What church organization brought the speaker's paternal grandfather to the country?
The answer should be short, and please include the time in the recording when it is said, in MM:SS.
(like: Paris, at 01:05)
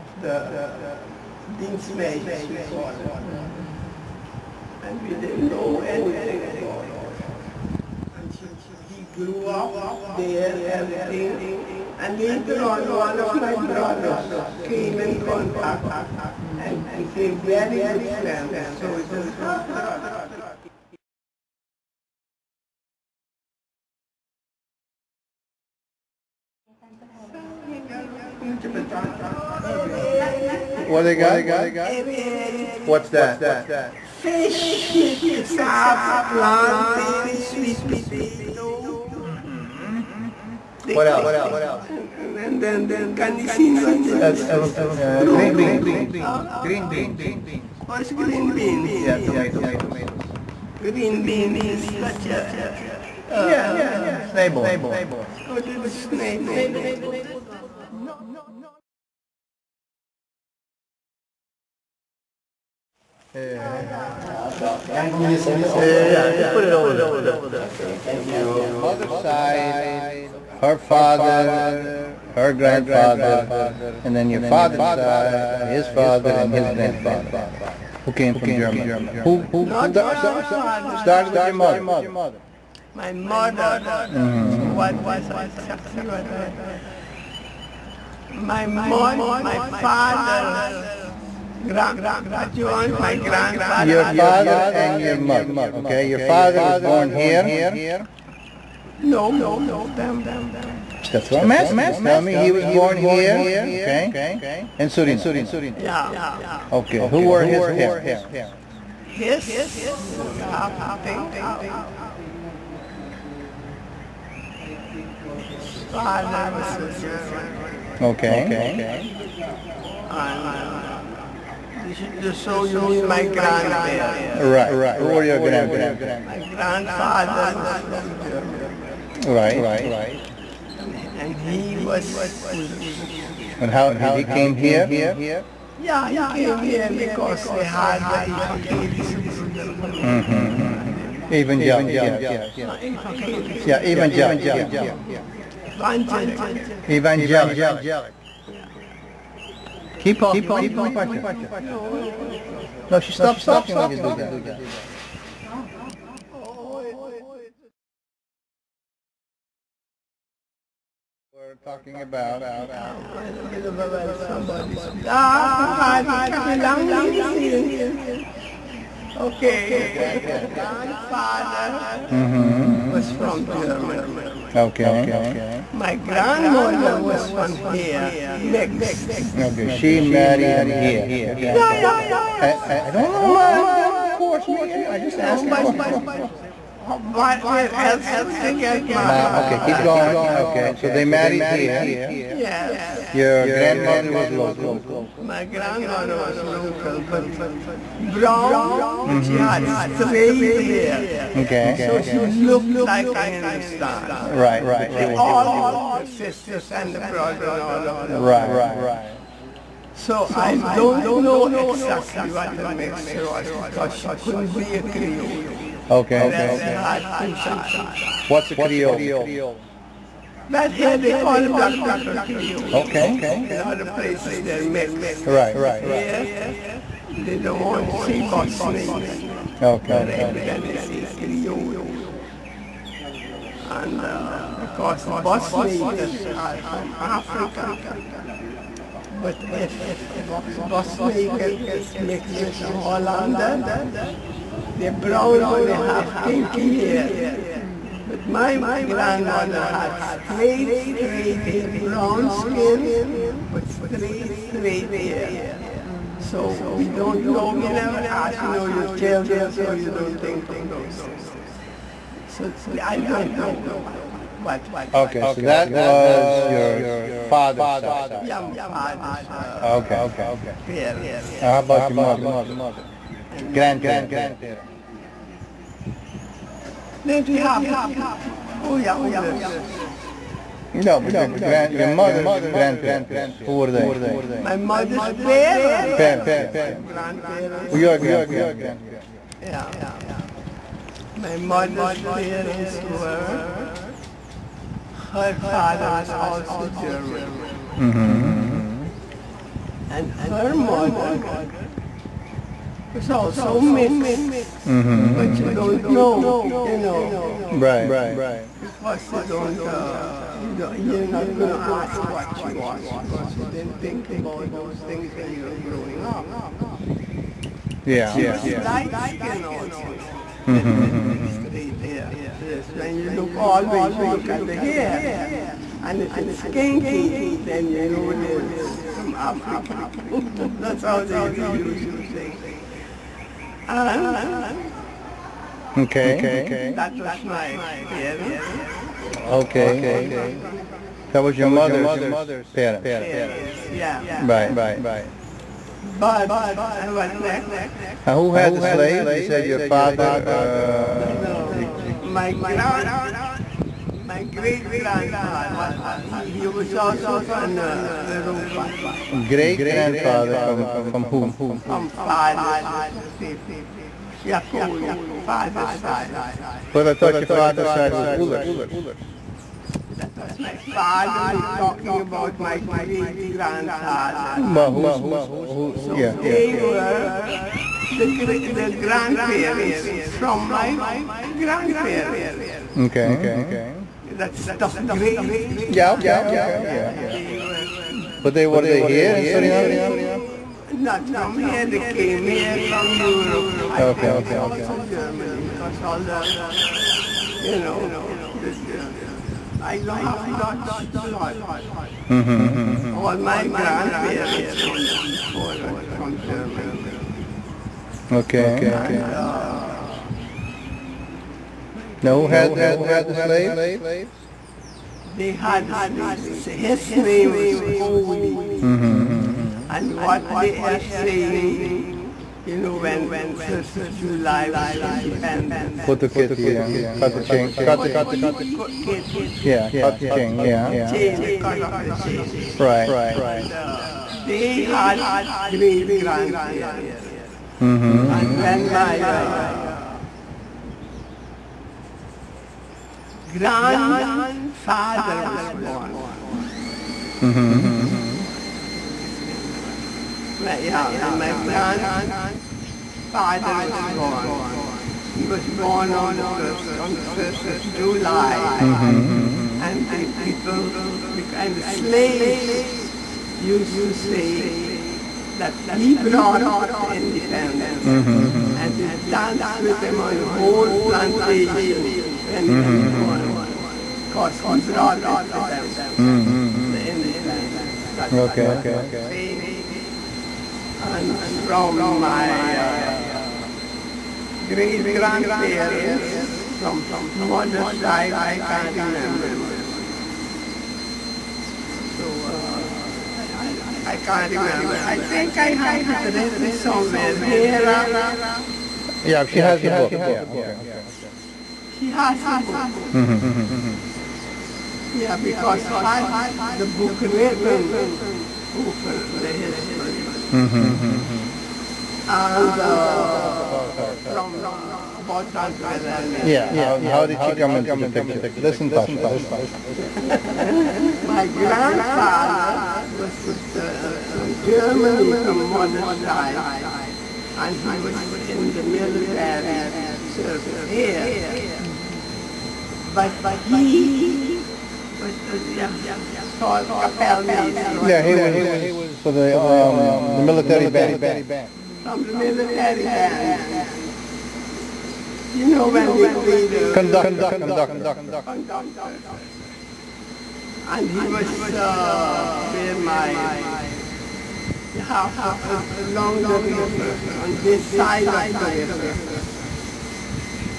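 Evangelische Broedergemeente, at 02:18.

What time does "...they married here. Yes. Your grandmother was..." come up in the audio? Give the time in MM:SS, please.
03:10.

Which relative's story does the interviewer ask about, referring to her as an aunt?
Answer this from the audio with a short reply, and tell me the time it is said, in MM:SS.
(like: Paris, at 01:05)
Tante Wilhelmina, at 08:35.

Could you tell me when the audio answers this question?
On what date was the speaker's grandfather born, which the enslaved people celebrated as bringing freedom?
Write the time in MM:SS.
07:36.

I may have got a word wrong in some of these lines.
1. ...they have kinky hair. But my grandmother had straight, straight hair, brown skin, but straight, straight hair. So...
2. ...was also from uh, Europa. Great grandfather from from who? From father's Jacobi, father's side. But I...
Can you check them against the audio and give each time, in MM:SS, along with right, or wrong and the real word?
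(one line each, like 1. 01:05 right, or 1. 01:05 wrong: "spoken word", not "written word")
1. 04:05 right
2. 05:56 right.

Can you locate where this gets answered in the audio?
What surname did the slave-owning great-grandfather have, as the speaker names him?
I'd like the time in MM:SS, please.
06:57.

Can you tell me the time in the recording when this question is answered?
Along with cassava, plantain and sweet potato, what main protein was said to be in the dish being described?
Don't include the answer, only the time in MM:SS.
00:34.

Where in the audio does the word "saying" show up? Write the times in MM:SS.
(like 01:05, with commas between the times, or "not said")
07:00, 07:59.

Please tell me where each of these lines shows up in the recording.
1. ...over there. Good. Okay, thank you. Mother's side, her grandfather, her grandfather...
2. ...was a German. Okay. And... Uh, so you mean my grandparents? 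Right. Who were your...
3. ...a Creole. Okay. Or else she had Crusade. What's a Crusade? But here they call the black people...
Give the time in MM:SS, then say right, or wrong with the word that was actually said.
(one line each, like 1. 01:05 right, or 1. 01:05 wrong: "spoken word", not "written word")
1. 01:06 wrong: "father", not "grandfather"
2. 01:56 right
3. 03:34 wrong: "Creole", not "Crusade".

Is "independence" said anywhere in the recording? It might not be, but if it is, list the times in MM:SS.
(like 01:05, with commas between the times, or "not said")
07:04, 07:47, 07:56.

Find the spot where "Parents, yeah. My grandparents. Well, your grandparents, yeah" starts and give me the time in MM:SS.
04:45.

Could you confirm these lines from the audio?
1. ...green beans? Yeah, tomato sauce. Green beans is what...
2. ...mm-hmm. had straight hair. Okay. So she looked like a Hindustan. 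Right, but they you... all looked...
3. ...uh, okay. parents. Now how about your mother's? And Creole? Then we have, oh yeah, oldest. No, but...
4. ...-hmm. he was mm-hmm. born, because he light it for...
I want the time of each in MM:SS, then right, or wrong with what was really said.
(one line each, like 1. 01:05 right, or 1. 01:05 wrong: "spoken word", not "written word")
1. 00:48 right
2. 03:19 right
3. 04:29 wrong: "Grandparents", not "Creole"
4. 07:52 wrong: "brought", not "light".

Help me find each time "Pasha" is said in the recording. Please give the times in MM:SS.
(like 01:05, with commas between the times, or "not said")
02:30, 08:38.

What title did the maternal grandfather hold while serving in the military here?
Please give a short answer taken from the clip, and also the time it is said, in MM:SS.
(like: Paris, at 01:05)
Kapellmeister, at 08:56.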